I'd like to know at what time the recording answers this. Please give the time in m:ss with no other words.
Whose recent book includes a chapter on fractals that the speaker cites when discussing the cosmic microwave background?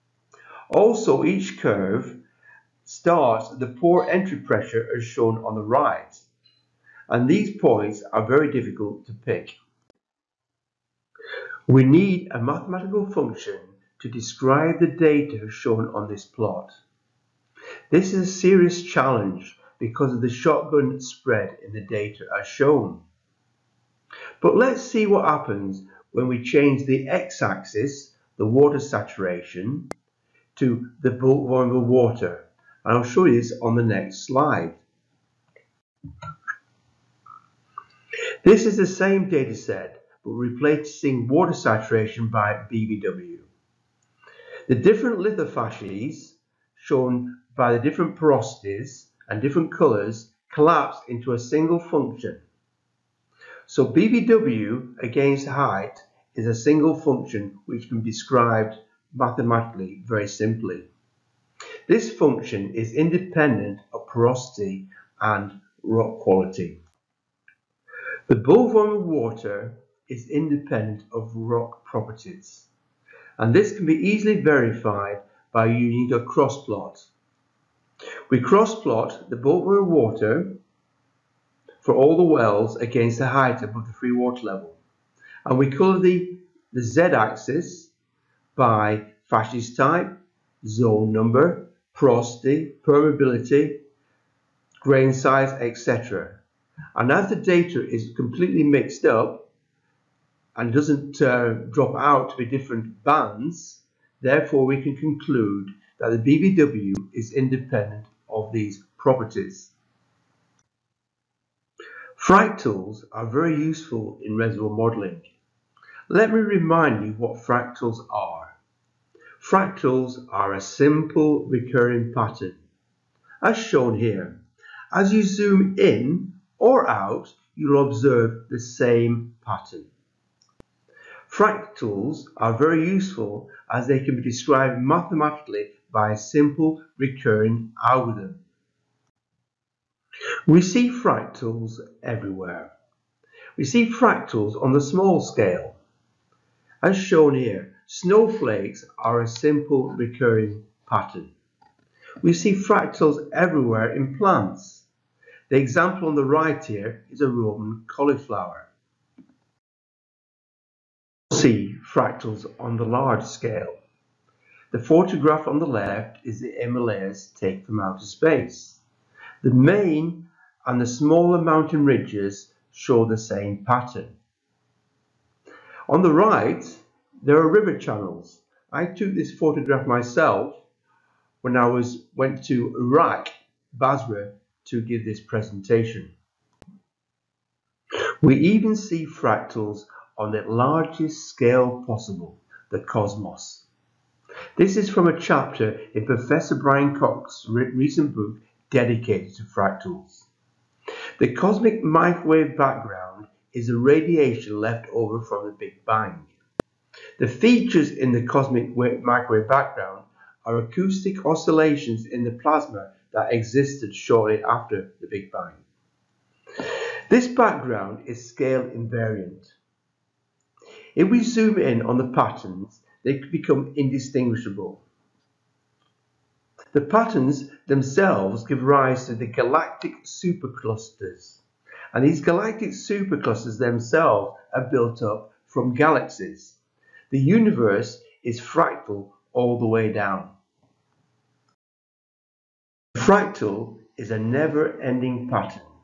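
3:16.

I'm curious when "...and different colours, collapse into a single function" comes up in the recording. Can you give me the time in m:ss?
0:49.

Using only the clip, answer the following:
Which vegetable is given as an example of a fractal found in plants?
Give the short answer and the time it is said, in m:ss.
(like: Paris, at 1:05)
Roman cauliflower, at 2:37.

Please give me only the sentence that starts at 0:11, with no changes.
We need a mathematical function to describe the data shown on this plot.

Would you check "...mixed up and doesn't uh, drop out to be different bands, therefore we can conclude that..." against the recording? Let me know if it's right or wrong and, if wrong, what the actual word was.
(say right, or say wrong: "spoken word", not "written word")
right.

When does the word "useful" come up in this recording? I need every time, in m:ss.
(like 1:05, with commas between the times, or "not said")
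1:53, 2:12.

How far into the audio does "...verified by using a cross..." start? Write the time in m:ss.
1:14.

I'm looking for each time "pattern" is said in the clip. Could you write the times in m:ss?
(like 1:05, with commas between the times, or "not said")
2:02, 2:09, 2:30, 2:53, 3:42, 3:46, 4:05.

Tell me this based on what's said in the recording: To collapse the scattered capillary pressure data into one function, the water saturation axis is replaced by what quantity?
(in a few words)
Bulk volume water.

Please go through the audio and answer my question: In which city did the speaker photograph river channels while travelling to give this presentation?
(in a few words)
Basra.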